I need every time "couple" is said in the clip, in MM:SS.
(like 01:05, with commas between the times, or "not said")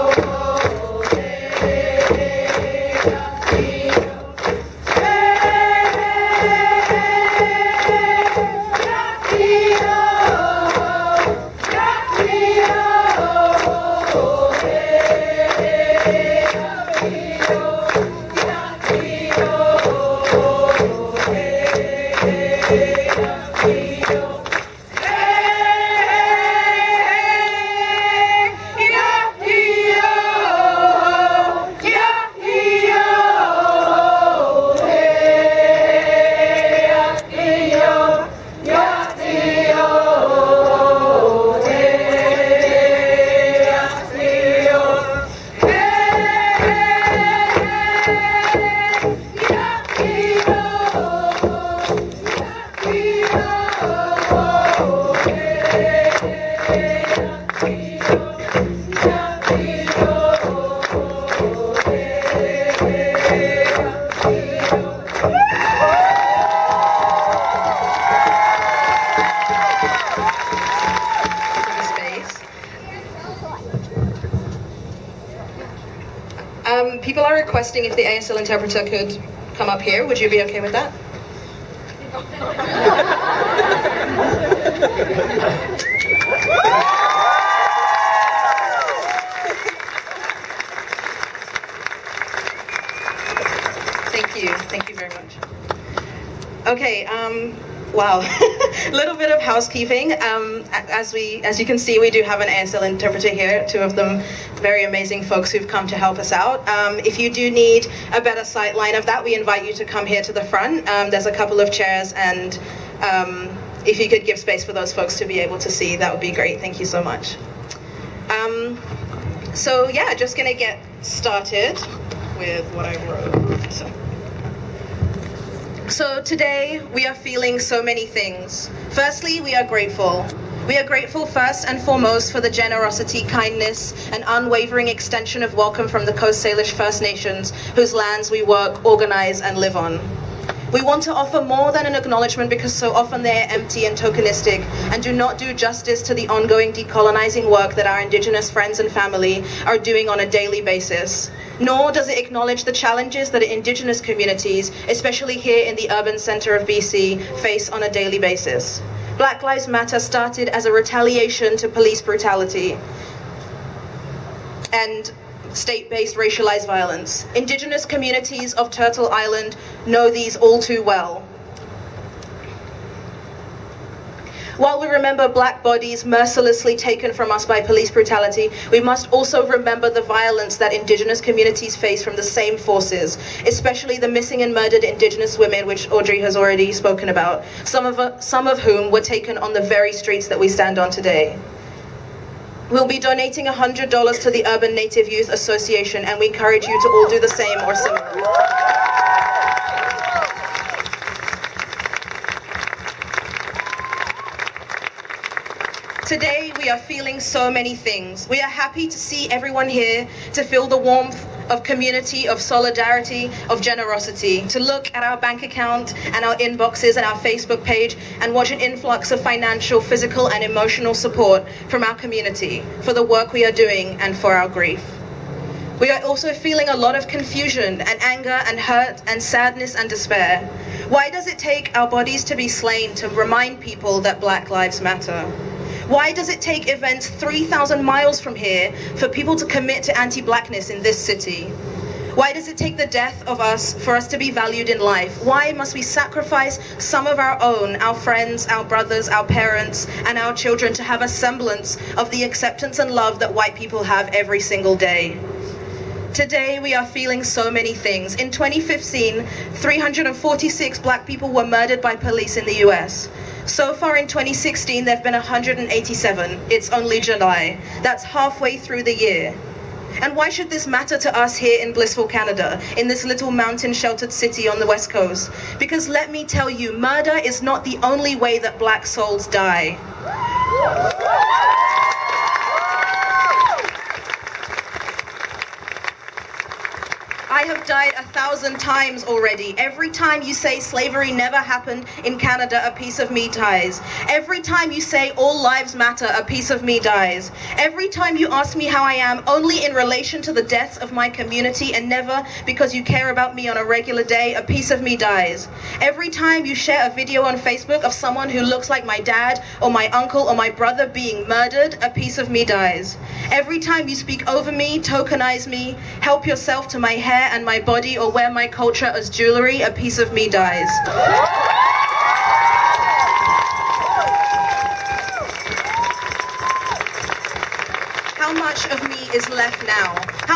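01:51.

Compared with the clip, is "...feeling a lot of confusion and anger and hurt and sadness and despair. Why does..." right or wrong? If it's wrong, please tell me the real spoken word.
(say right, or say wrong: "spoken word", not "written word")
right.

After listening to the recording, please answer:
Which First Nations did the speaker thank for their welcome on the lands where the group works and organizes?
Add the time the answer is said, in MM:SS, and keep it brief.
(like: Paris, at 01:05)
Coast Salish, at 02:16.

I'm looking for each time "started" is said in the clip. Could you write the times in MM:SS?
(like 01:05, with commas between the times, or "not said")
02:01, 02:39.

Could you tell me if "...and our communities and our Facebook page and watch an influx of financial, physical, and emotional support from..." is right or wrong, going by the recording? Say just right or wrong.
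wrong.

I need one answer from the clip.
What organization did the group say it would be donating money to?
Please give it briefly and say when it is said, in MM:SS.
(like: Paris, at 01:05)
Urban Native Youth Association, at 03:14.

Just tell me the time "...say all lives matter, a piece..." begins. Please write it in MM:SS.
04:54.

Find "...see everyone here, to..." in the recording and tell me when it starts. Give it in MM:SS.
03:28.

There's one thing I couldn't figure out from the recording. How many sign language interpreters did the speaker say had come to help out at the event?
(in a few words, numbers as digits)
2.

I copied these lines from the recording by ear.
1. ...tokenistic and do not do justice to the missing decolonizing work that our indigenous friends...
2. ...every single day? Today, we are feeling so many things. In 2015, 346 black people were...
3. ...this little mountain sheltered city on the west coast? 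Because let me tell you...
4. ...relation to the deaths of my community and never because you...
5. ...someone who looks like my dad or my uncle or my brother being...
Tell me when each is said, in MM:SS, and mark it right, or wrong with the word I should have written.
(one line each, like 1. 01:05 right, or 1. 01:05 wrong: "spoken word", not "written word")
1. 02:23 wrong: "ongoing", not "missing"
2. 04:14 right
3. 04:32 right
4. 04:59 right
5. 05:07 right.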